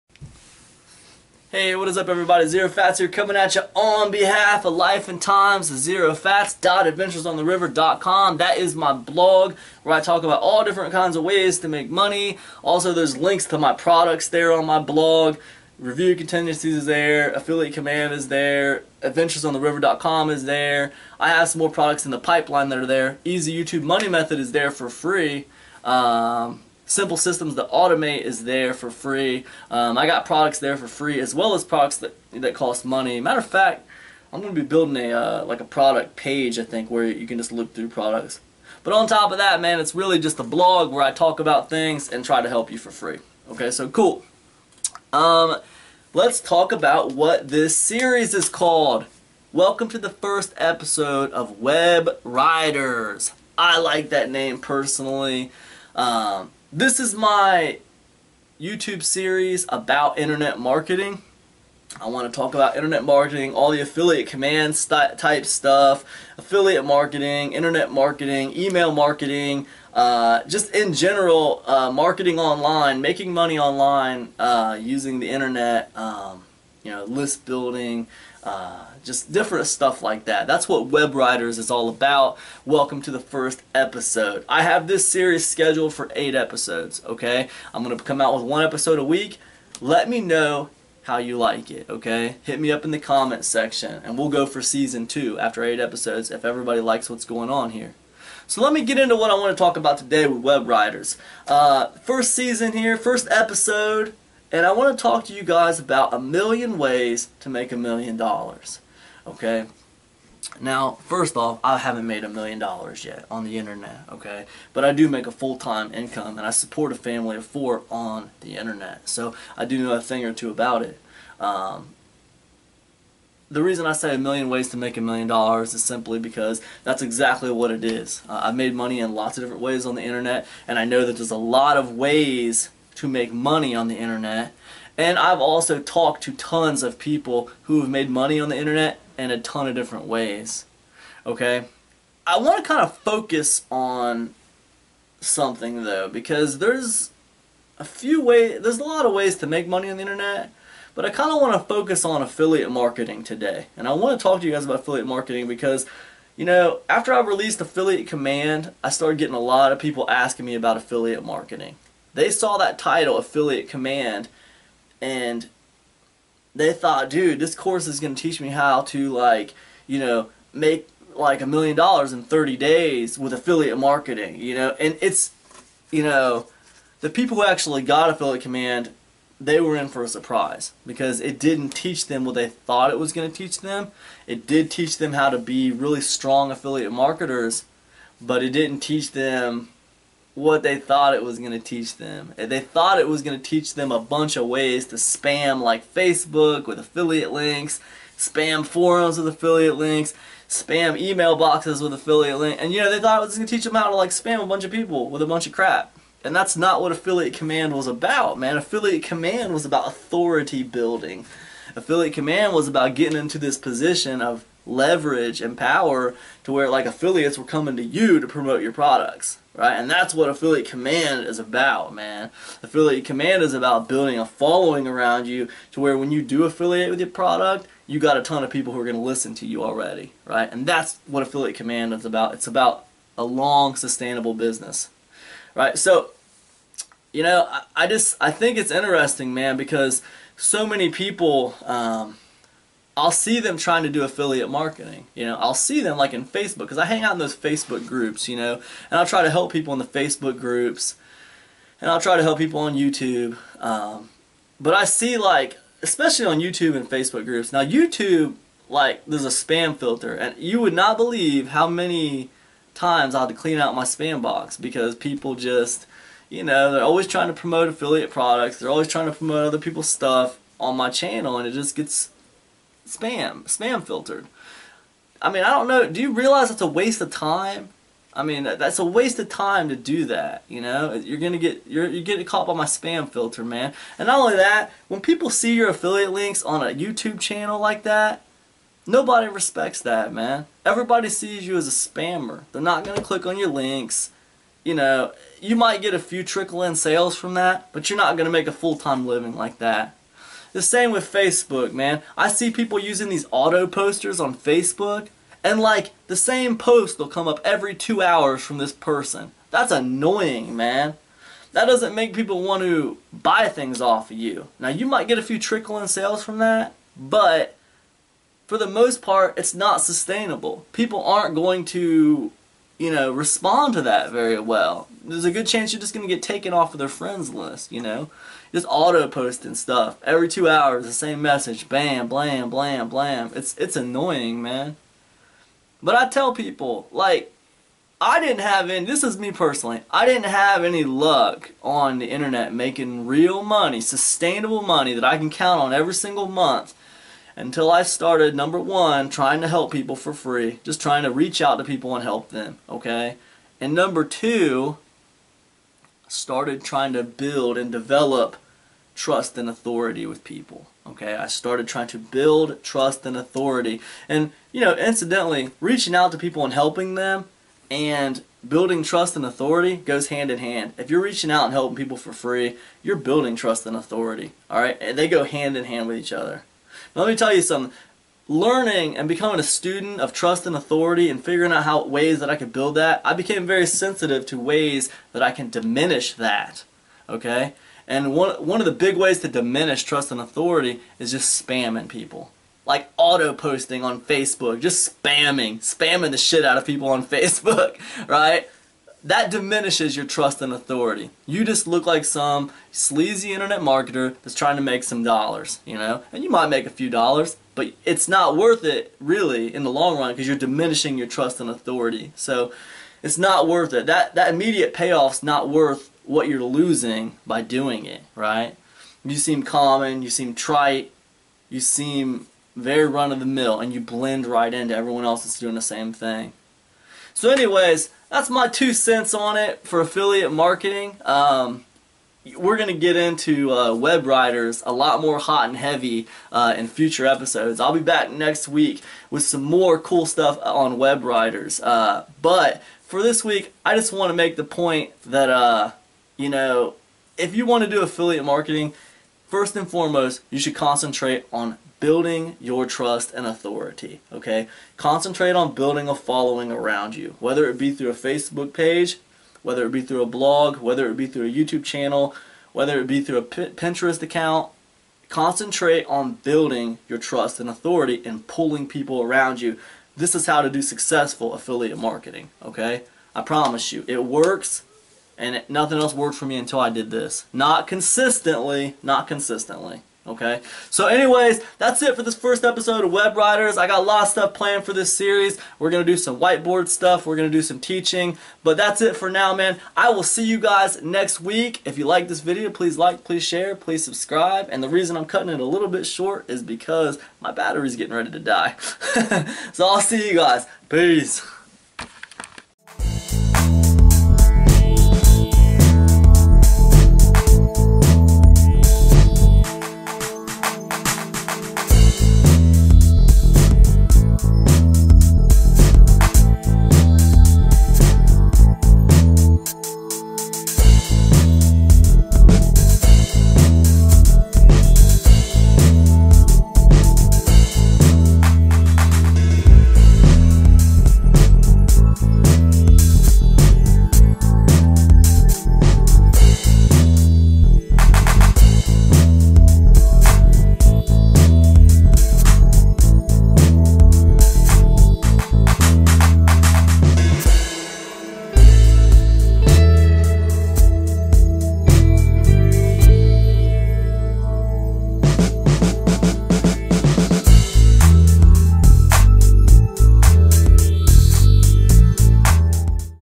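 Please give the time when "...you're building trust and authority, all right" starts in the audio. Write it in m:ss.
6:12.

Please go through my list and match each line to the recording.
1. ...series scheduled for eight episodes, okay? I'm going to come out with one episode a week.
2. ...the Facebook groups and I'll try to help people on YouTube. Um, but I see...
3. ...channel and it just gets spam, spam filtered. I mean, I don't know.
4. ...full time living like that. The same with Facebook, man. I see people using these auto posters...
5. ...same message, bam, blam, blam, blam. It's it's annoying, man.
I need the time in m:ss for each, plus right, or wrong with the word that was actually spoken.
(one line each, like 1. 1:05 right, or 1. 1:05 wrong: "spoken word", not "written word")
1. 1:25 right
2. 4:09 right
3. 4:30 right
4. 4:58 right
5. 5:30 right.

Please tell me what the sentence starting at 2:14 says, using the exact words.
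And I've also talked to tons of people who have made money on the internet in a ton of different ways.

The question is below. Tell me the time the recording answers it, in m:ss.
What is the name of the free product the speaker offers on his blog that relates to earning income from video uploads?
0:23.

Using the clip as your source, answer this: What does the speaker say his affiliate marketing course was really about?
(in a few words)
Authority building.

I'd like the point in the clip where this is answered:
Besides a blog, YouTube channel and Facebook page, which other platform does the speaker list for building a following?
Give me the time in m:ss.
7:43.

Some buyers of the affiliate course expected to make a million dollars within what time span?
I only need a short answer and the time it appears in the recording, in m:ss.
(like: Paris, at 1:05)
30 days, at 2:52.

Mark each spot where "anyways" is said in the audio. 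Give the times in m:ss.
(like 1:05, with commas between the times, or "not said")
7:07, 8:00.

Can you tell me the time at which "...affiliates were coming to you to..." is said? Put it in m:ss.
3:36.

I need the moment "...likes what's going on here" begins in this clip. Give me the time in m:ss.
1:36.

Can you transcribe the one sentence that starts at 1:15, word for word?
Um, you know, list building, uh, just different stuff like that.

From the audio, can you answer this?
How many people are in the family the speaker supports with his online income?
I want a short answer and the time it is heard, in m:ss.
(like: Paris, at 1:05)
4, at 1:56.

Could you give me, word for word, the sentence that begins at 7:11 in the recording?
Um, we're going to get into uh, web writers a lot more hot and heavy uh, in future episodes.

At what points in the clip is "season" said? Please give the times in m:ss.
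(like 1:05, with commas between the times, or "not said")
1:34, 1:42.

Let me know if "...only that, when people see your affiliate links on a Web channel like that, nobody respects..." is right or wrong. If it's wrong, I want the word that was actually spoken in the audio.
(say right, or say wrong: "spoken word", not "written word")
wrong: "YouTube", not "Web".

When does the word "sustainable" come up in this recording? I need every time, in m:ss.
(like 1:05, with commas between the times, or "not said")
3:53, 5:19, 5:43.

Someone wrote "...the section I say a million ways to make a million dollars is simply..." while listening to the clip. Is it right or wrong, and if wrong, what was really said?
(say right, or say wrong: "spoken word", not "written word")
wrong: "reason", not "section".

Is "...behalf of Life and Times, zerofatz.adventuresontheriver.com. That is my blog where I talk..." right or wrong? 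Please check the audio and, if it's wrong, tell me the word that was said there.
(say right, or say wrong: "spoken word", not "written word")
right.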